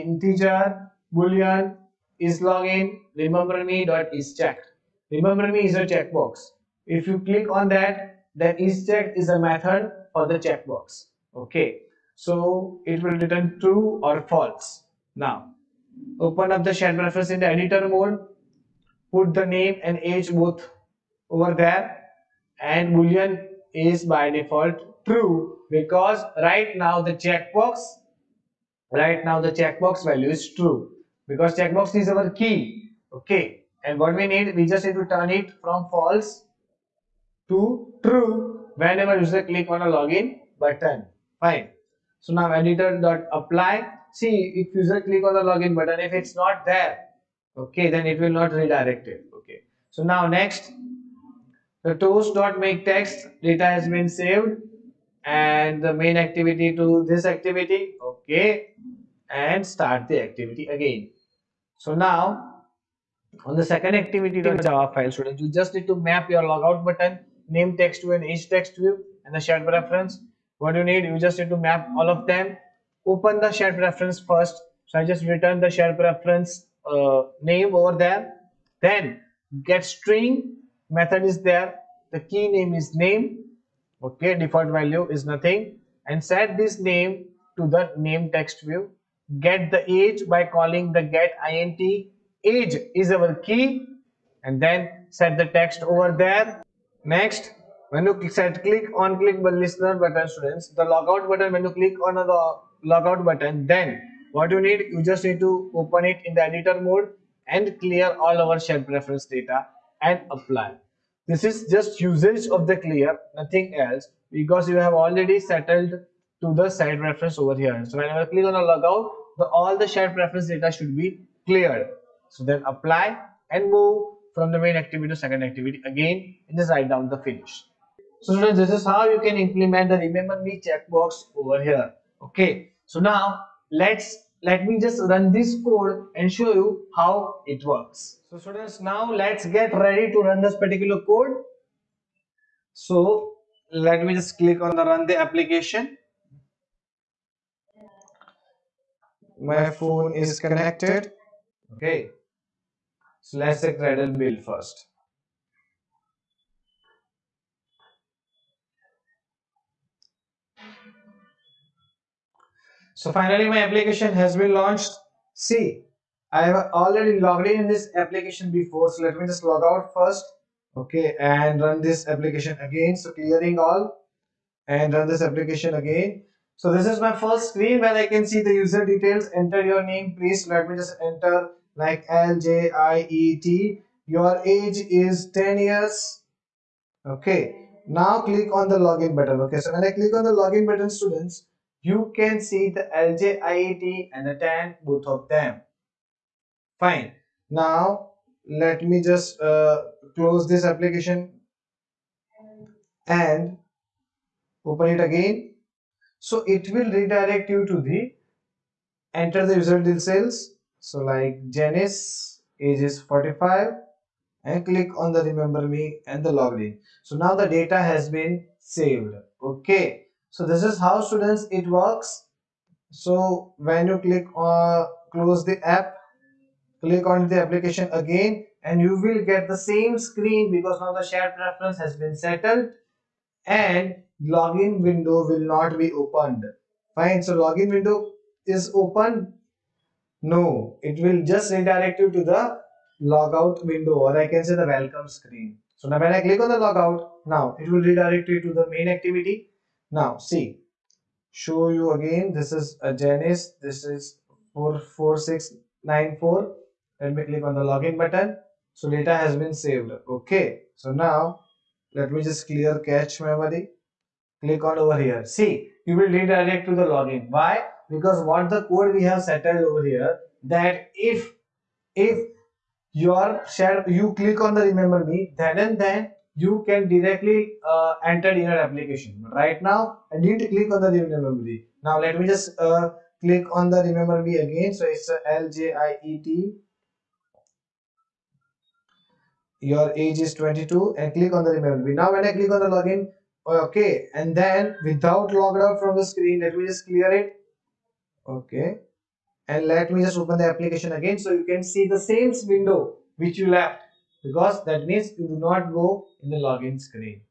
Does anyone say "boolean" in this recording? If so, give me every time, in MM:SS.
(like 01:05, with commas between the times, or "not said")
00:01, 00:22.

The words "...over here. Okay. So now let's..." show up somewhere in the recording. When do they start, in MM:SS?
02:11.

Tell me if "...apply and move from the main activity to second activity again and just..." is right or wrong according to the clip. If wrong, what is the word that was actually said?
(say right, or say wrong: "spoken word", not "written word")
right.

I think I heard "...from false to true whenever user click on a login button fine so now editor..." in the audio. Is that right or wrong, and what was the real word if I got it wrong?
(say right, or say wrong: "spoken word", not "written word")
right.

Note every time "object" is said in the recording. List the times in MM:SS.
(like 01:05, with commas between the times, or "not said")
not said.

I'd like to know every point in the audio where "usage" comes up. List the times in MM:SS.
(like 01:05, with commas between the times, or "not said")
01:52.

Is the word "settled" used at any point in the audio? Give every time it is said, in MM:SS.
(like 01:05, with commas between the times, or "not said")
01:55, 03:52, 04:29.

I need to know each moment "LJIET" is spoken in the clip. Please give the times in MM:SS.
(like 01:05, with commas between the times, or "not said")
03:12.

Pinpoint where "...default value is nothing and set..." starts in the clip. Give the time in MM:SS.
01:24.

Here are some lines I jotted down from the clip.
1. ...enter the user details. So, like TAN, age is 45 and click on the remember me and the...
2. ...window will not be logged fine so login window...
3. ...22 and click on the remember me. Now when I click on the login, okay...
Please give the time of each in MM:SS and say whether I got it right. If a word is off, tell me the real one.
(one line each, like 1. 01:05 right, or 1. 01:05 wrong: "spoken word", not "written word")
1. 03:29 wrong: "Janice", not "TAN"
2. 03:54 wrong: "opened", not "logged"
3. 04:50 right.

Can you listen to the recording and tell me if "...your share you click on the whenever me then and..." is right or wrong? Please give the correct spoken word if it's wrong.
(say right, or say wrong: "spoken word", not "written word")
wrong: "remember", not "whenever".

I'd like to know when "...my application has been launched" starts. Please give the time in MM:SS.
02:43.